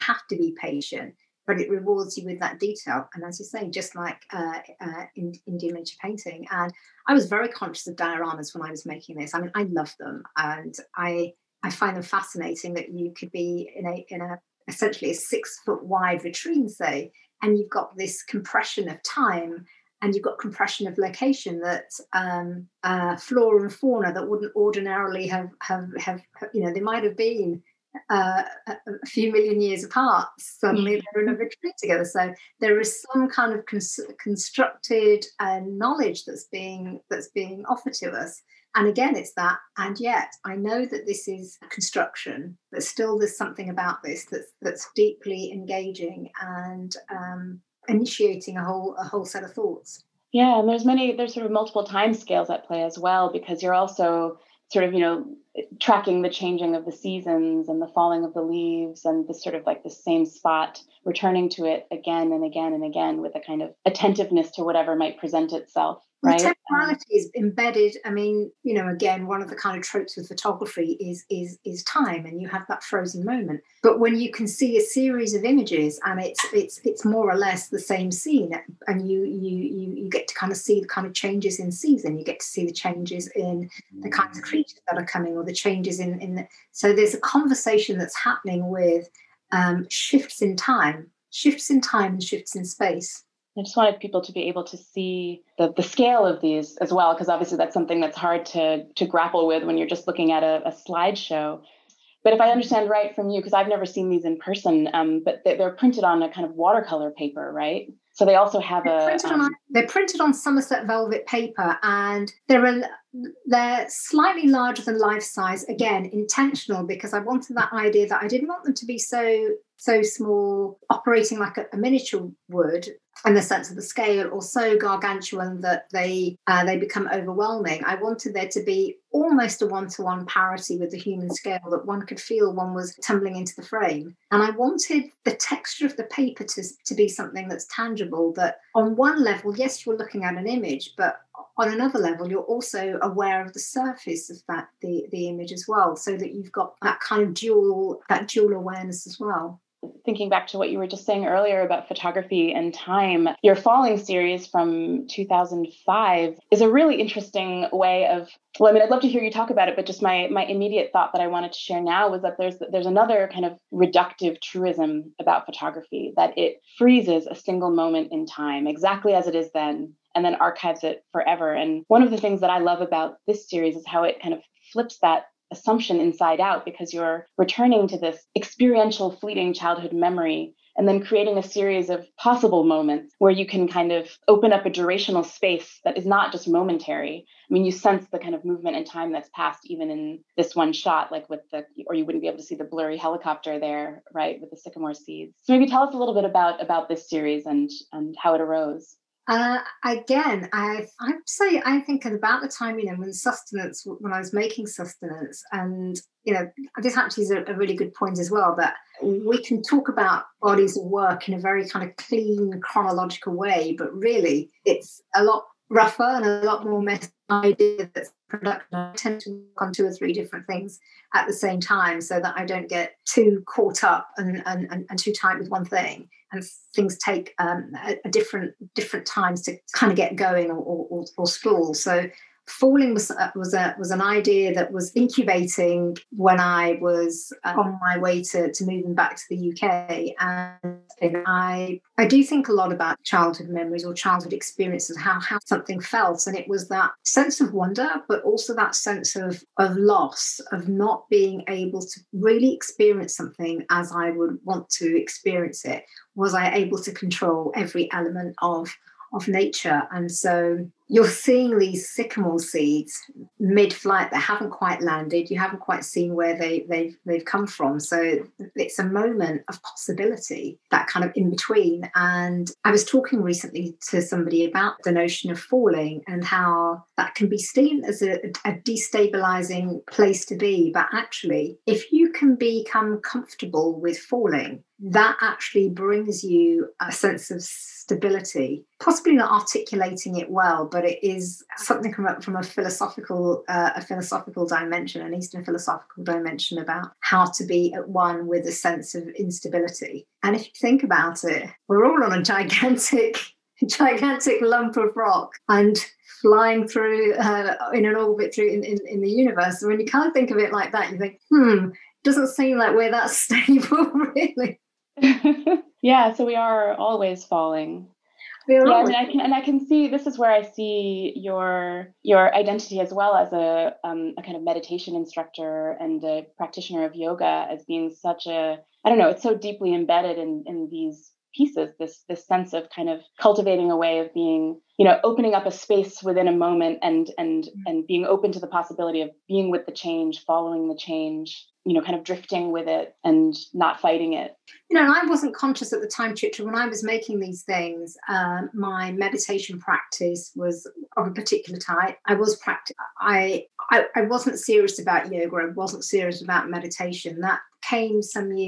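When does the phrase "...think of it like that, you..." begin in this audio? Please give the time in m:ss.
5:10.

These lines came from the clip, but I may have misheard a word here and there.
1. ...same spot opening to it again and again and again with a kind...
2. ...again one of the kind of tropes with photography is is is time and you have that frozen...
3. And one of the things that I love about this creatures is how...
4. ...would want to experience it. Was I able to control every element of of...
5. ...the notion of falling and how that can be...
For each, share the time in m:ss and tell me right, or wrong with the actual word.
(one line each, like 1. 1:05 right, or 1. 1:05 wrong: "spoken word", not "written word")
1. 0:59 wrong: "returning", not "opening"
2. 1:08 right
3. 2:51 wrong: "series", not "creatures"
4. 4:14 right
5. 4:34 right.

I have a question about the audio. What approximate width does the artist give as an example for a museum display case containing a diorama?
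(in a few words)
6 foot.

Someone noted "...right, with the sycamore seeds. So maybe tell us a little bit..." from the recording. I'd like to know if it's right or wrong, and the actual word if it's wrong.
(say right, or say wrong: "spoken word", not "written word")
right.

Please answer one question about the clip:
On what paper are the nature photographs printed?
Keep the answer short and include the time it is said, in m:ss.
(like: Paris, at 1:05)
Somerset velvet paper, at 1:50.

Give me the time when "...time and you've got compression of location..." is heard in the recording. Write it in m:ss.
0:19.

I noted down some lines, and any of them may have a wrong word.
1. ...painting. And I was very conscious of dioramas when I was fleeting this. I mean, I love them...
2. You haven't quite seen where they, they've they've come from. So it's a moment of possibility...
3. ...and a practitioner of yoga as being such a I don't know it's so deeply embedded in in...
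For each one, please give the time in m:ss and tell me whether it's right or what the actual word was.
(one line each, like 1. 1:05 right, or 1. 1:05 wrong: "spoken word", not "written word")
1. 0:06 wrong: "making", not "fleeting"
2. 4:25 right
3. 5:25 right.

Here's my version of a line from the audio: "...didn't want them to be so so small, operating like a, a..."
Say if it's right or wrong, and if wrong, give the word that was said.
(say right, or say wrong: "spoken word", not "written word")
right.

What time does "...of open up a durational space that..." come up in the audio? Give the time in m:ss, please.
3:03.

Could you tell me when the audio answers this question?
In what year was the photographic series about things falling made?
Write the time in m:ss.
2:35.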